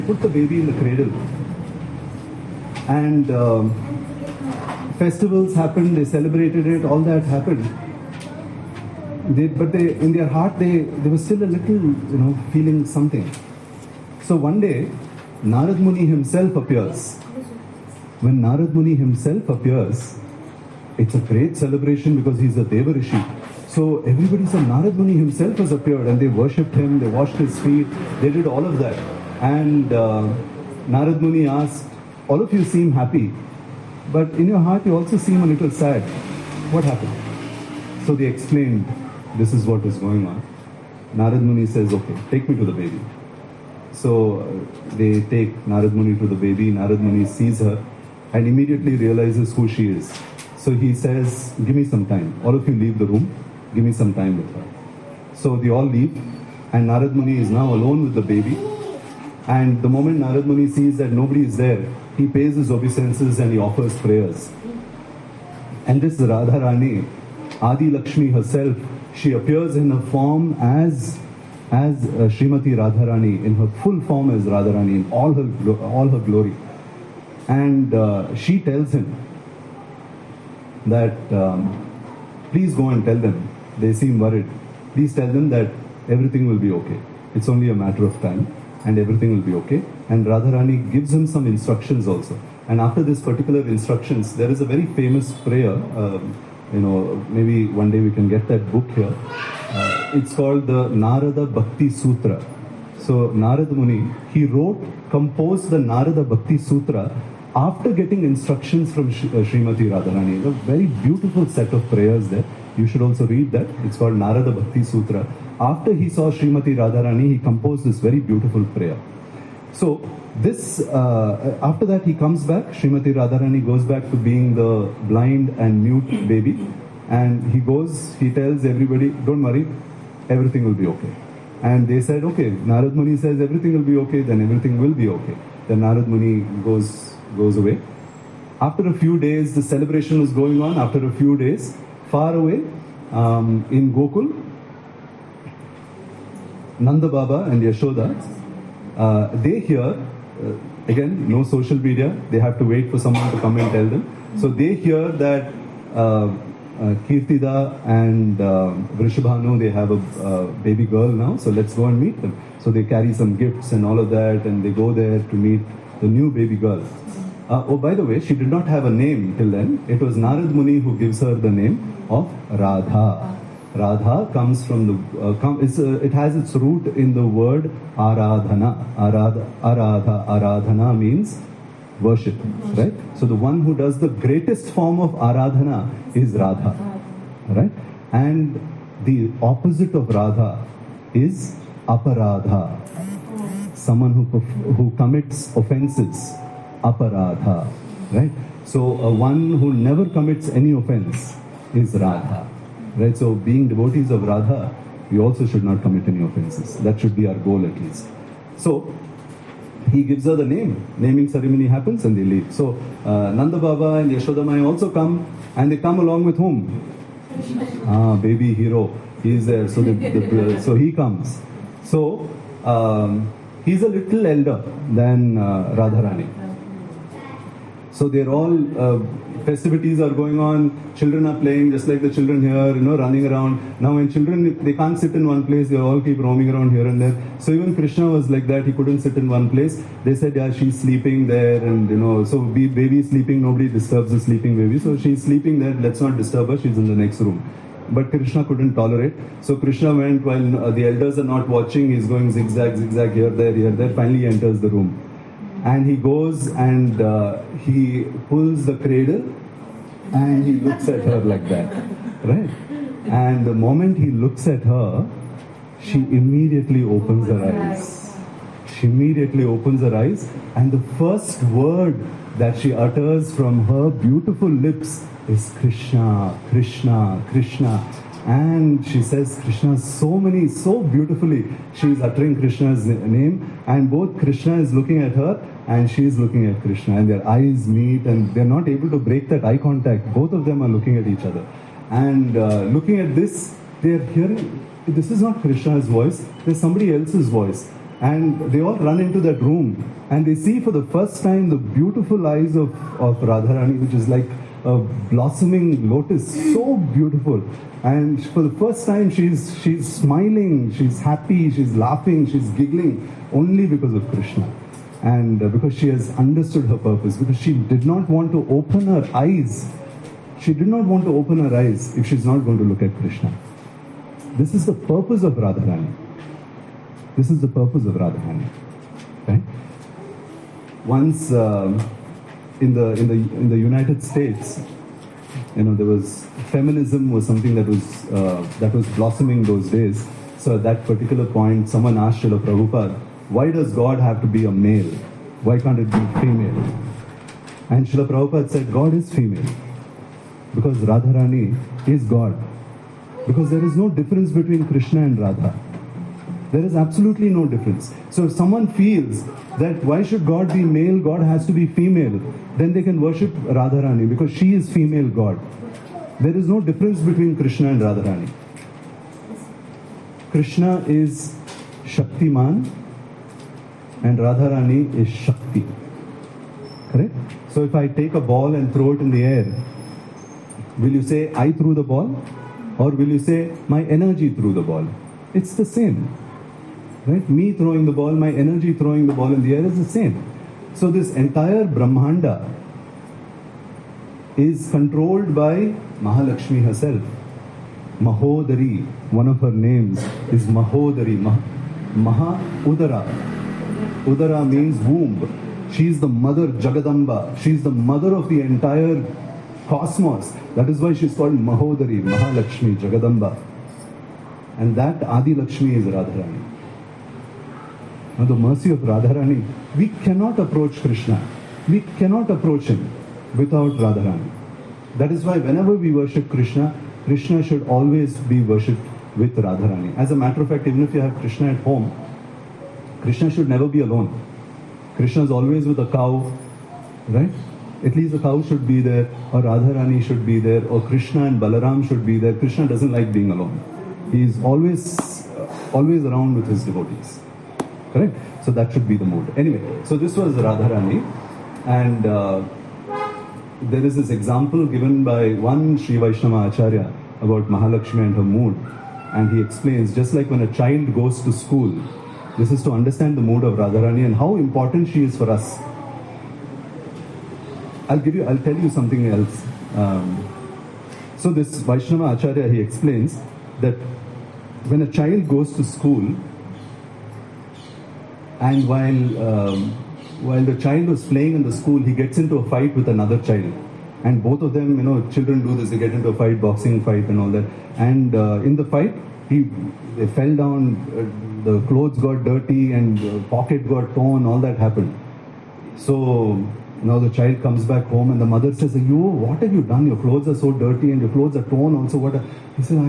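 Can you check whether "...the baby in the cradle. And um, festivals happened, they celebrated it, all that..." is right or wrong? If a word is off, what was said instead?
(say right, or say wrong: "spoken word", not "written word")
right.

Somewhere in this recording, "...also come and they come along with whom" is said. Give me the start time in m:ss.
3:34.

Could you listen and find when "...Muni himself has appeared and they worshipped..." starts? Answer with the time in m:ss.
0:24.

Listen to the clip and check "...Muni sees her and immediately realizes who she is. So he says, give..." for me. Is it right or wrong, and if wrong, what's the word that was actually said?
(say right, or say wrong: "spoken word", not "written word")
right.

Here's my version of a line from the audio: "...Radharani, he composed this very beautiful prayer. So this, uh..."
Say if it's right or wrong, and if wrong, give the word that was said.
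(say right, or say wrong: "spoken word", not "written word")
right.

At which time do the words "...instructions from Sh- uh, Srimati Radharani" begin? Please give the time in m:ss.
1:48.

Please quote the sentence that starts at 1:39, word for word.
Uh, it's called the Narada Bhakti Sutra.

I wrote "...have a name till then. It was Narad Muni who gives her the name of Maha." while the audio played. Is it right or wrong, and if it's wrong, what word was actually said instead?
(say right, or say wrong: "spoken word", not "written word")
wrong: "Radha", not "Maha".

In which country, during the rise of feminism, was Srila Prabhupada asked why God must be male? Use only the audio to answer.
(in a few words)
United States.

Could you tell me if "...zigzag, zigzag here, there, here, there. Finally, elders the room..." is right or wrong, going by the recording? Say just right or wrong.
wrong.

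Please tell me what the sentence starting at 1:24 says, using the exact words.
Please tell them that everything will be okay.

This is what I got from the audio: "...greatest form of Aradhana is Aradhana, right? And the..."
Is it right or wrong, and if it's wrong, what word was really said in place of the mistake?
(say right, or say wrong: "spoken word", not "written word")
wrong: "Radha", not "Aradhana".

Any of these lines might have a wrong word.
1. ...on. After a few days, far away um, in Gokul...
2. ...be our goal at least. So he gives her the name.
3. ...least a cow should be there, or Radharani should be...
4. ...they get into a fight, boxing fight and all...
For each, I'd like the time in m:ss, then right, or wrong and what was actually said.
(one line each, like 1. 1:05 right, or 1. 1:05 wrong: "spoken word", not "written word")
1. 2:20 right
2. 3:27 right
3. 7:17 right
4. 8:05 right.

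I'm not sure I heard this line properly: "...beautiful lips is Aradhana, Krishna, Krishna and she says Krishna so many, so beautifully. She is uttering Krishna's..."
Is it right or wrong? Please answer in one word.
wrong.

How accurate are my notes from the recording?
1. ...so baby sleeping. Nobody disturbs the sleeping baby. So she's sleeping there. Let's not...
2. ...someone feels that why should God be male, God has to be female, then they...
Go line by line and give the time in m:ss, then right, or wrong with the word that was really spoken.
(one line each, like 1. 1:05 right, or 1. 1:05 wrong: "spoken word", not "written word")
1. 4:02 right
2. 5:58 right.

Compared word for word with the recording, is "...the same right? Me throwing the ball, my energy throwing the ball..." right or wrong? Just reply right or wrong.
right.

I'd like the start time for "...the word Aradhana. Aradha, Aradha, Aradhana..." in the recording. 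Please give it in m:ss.
2:57.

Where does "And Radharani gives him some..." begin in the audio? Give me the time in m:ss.
1:30.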